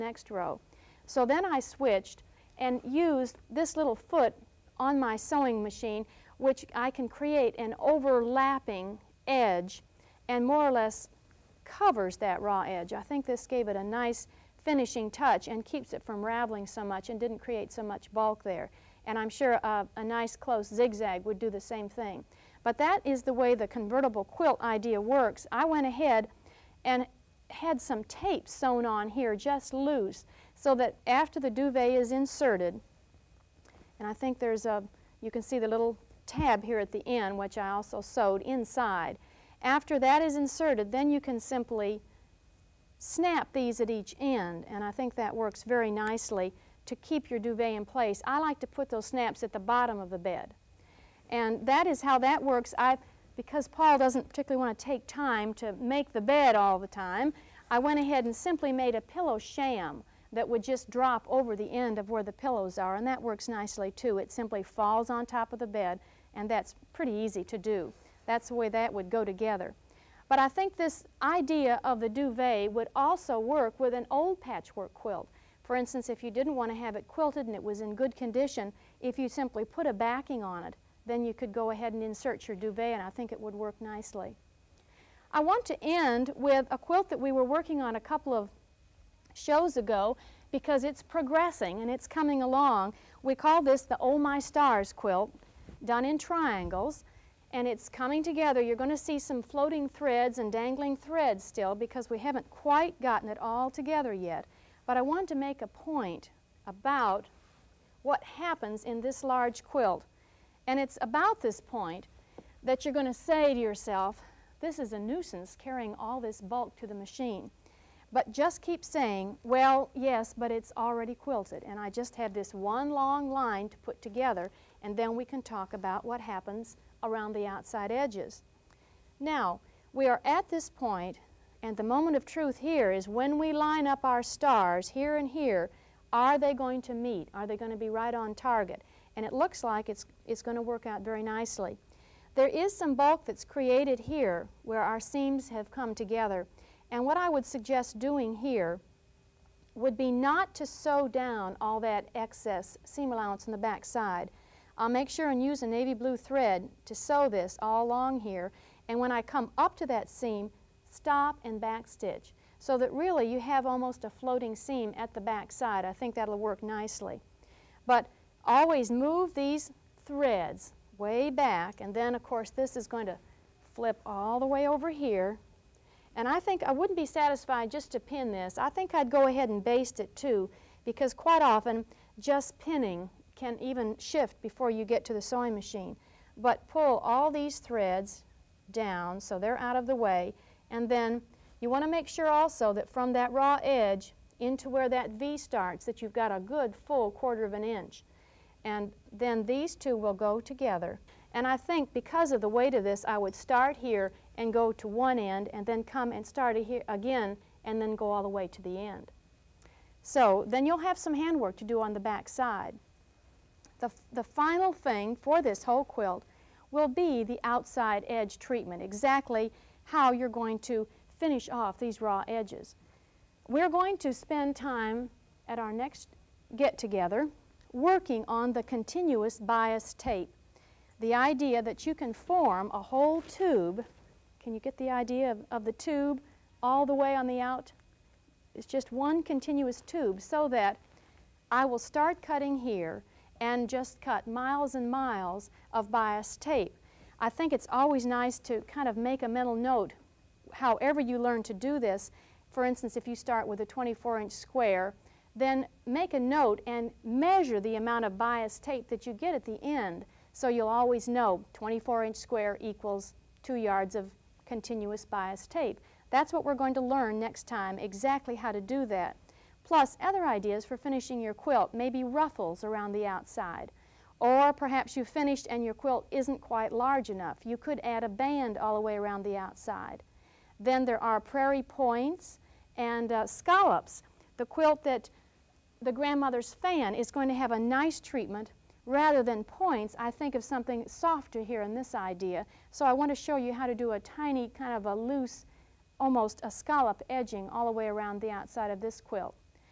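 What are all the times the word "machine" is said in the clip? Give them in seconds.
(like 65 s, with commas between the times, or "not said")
5 s, 116 s, 185 s.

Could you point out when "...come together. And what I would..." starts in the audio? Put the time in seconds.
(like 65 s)
145 s.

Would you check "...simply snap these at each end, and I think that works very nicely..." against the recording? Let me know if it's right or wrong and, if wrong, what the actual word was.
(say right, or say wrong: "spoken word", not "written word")
right.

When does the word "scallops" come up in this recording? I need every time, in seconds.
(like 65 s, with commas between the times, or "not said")
283 s, 296 s.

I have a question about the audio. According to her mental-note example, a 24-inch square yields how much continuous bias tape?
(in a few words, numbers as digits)
2 yards.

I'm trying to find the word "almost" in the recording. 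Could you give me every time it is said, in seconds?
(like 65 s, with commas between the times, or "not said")
163 s, 296 s.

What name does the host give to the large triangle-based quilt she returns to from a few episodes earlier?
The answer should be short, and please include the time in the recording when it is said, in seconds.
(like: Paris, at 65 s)
Oh My Stars, at 93 s.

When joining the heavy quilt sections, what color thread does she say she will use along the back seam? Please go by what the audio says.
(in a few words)
navy blue.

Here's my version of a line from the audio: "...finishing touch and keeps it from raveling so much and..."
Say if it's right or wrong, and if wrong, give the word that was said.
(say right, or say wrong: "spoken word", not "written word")
right.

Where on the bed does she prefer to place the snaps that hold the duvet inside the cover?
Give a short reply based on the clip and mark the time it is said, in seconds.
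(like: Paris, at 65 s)
at the bottom, at 49 s.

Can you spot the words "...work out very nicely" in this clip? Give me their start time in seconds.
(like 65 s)
140 s.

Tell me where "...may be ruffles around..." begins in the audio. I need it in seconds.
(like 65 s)
271 s.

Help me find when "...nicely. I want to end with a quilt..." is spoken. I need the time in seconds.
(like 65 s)
83 s.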